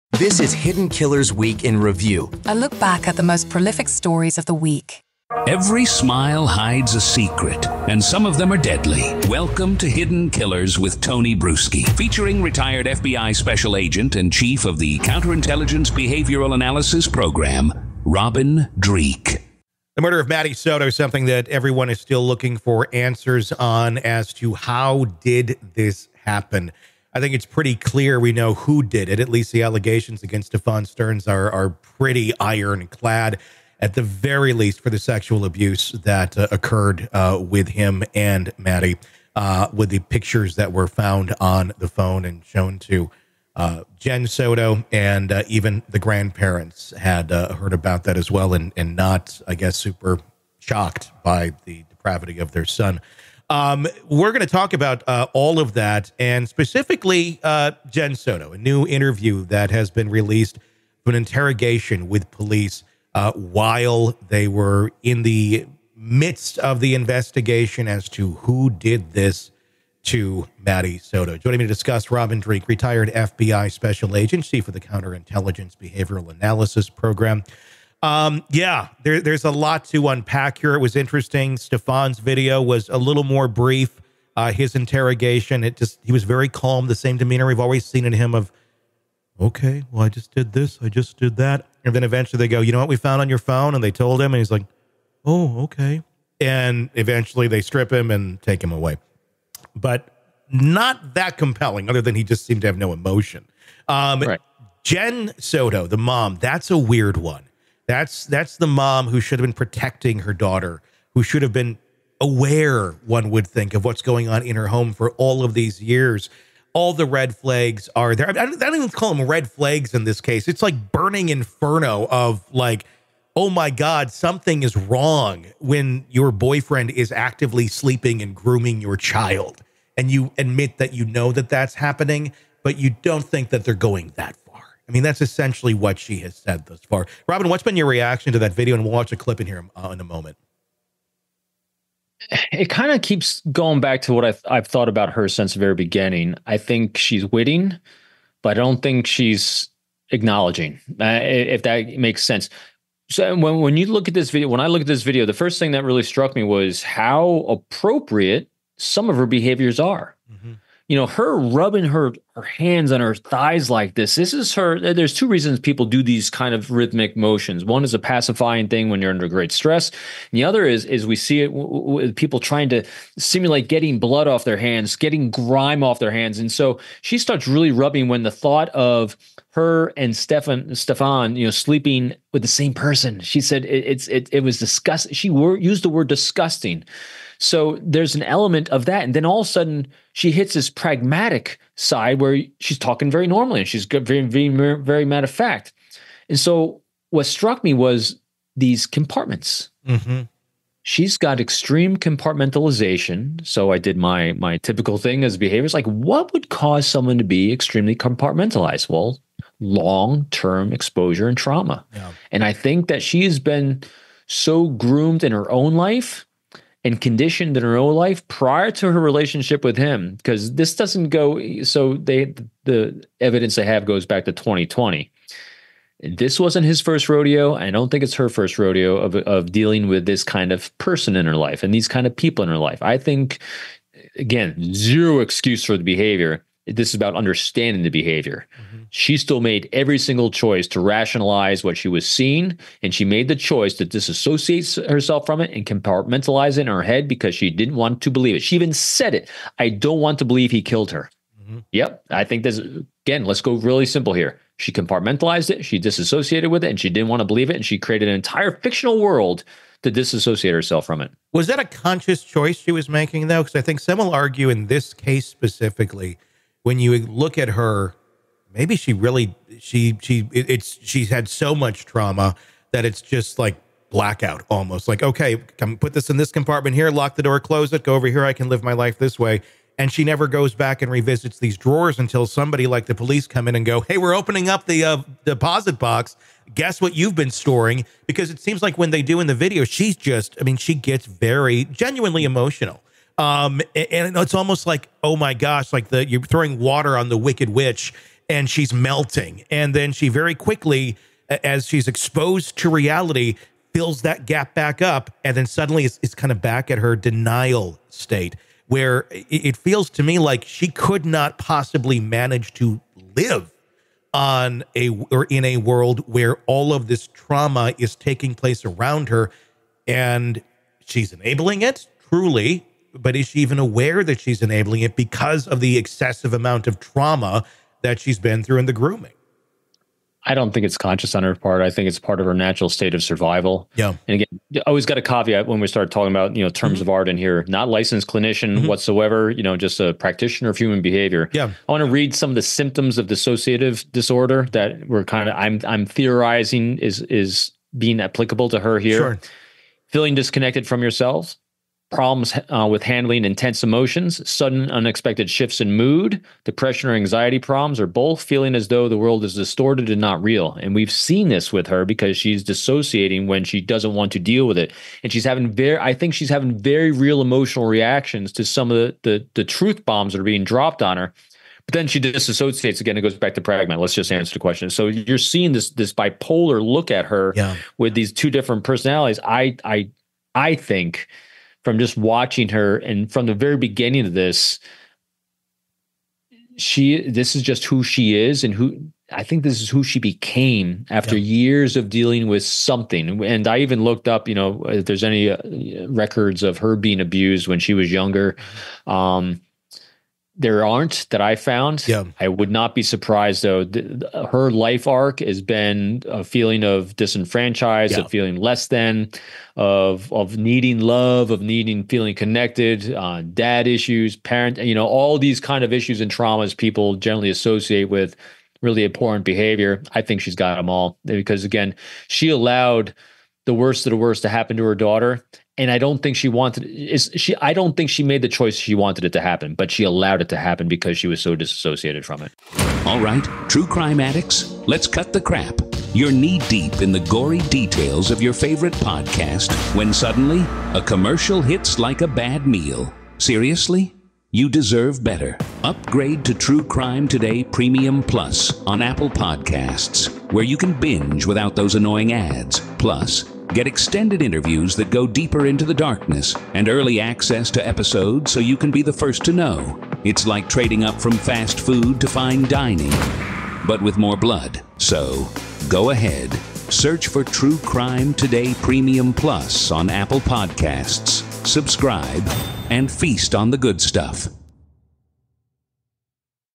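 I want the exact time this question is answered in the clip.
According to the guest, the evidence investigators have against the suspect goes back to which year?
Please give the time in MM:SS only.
03:44.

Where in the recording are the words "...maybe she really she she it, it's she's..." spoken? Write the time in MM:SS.
04:28.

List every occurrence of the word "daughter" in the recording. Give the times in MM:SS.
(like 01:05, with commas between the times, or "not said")
01:50, 07:04.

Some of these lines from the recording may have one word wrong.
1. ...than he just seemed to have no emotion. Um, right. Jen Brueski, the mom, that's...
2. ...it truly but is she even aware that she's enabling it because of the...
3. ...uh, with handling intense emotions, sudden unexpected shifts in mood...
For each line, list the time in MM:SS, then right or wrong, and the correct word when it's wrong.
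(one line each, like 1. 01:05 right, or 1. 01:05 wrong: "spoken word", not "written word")
1. 01:42 wrong: "Soto", not "Brueski"
2. 05:21 right
3. 05:52 right.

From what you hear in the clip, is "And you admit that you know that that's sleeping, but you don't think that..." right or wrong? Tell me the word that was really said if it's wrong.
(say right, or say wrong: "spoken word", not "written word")
wrong: "happening", not "sleeping".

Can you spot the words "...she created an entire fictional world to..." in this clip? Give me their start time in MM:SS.
04:17.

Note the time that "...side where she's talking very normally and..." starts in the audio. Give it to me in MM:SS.
03:11.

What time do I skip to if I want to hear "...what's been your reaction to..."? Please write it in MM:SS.
02:17.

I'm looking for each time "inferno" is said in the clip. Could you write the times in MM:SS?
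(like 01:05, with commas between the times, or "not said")
02:01.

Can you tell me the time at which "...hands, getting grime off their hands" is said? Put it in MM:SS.
02:54.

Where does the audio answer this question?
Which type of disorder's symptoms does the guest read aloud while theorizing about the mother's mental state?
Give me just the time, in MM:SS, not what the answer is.
05:43.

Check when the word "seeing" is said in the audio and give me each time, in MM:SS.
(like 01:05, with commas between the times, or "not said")
04:02, 06:15.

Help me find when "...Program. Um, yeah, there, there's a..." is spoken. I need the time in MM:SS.
01:16.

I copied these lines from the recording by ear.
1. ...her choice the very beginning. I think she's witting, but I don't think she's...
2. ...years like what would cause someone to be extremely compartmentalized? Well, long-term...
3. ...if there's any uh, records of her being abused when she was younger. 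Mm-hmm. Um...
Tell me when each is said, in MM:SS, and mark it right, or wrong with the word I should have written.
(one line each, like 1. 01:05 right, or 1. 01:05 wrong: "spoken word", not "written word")
1. 02:25 wrong: "since", not "choice"
2. 03:25 wrong: "behaviors", not "years"
3. 06:34 right.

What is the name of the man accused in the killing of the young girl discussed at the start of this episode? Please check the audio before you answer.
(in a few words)
Stephan Sterns.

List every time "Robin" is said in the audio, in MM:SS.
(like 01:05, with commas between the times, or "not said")
00:18, 01:12, 02:17.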